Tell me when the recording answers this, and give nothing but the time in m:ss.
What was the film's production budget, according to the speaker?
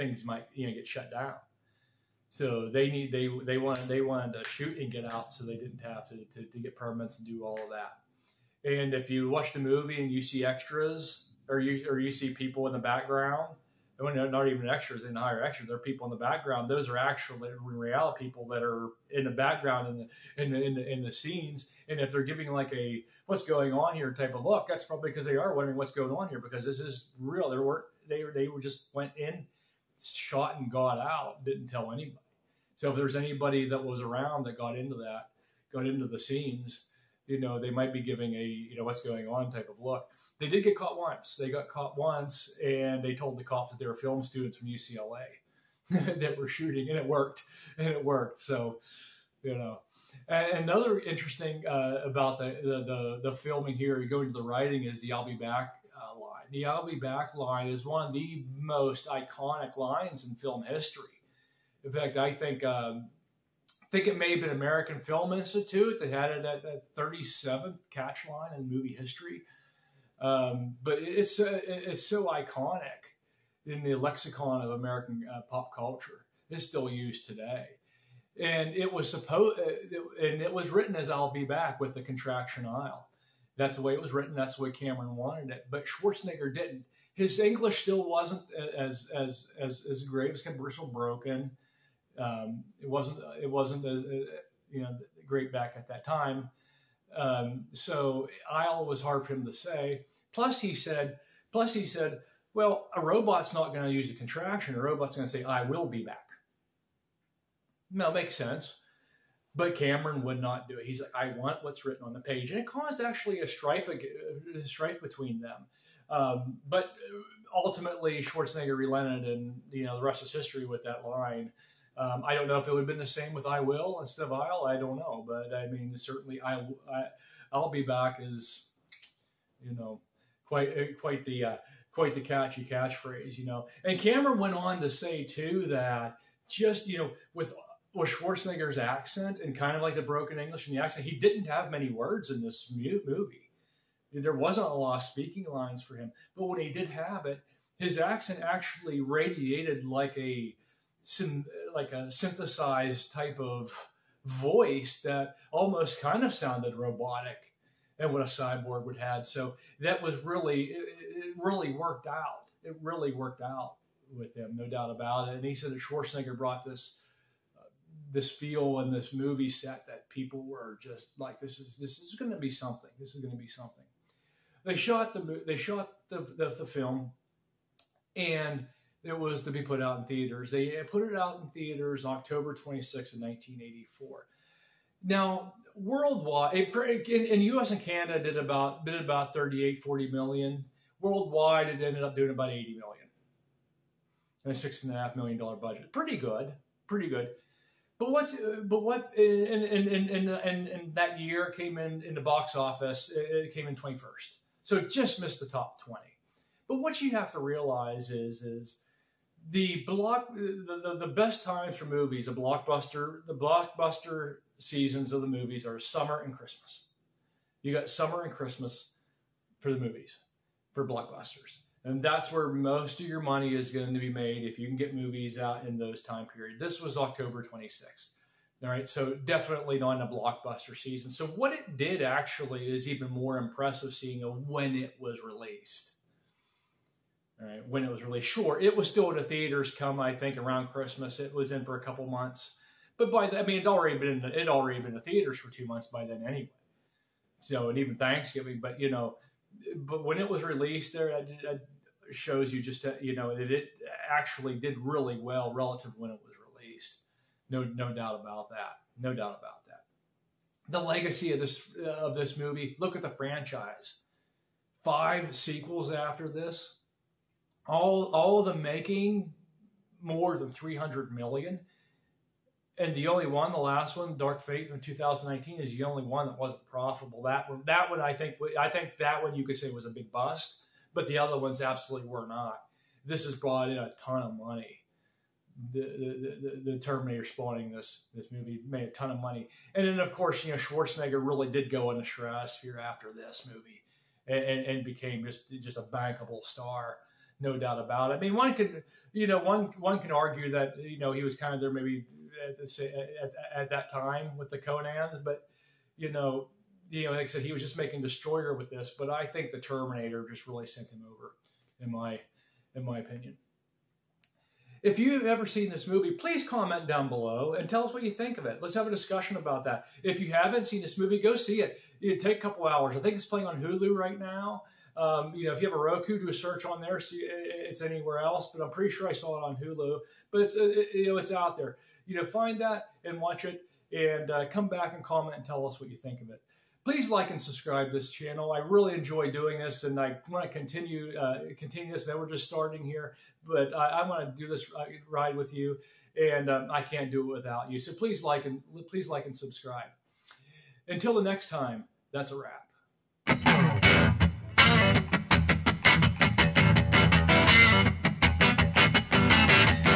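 3:14.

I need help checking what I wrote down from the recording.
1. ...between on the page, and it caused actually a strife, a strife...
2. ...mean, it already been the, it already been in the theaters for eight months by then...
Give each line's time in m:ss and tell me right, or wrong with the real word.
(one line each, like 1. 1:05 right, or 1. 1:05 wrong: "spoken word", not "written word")
1. 1:51 wrong: "written", not "between"
2. 4:03 wrong: "two", not "eight".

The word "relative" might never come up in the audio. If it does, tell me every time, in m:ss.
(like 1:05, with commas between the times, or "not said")
4:15.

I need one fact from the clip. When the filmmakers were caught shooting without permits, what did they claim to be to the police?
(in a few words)
Film students from UCLA.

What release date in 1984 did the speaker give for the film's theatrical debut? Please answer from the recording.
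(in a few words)
October 26th.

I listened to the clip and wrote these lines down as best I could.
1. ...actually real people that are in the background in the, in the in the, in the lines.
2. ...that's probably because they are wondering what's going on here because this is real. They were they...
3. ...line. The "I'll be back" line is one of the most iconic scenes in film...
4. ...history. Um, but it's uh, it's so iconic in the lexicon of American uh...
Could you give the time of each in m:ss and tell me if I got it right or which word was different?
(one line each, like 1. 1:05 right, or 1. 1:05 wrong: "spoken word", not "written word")
1. 0:16 wrong: "scenes", not "lines"
2. 0:24 right
3. 0:56 wrong: "lines", not "scenes"
4. 1:08 right.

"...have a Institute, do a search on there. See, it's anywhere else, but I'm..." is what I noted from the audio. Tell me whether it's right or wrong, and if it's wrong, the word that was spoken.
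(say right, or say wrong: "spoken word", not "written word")
wrong: "Roku", not "Institute".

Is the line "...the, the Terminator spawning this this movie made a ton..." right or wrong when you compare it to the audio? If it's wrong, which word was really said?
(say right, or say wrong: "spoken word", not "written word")
right.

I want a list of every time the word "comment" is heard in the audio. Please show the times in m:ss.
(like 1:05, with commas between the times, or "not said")
5:16, 5:35.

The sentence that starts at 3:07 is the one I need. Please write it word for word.
and Canada, did about did about 38, 40 million.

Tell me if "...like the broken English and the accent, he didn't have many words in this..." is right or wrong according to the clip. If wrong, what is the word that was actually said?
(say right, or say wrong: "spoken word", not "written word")
right.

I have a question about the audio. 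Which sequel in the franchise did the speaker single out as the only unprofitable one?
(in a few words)
Dark Fate.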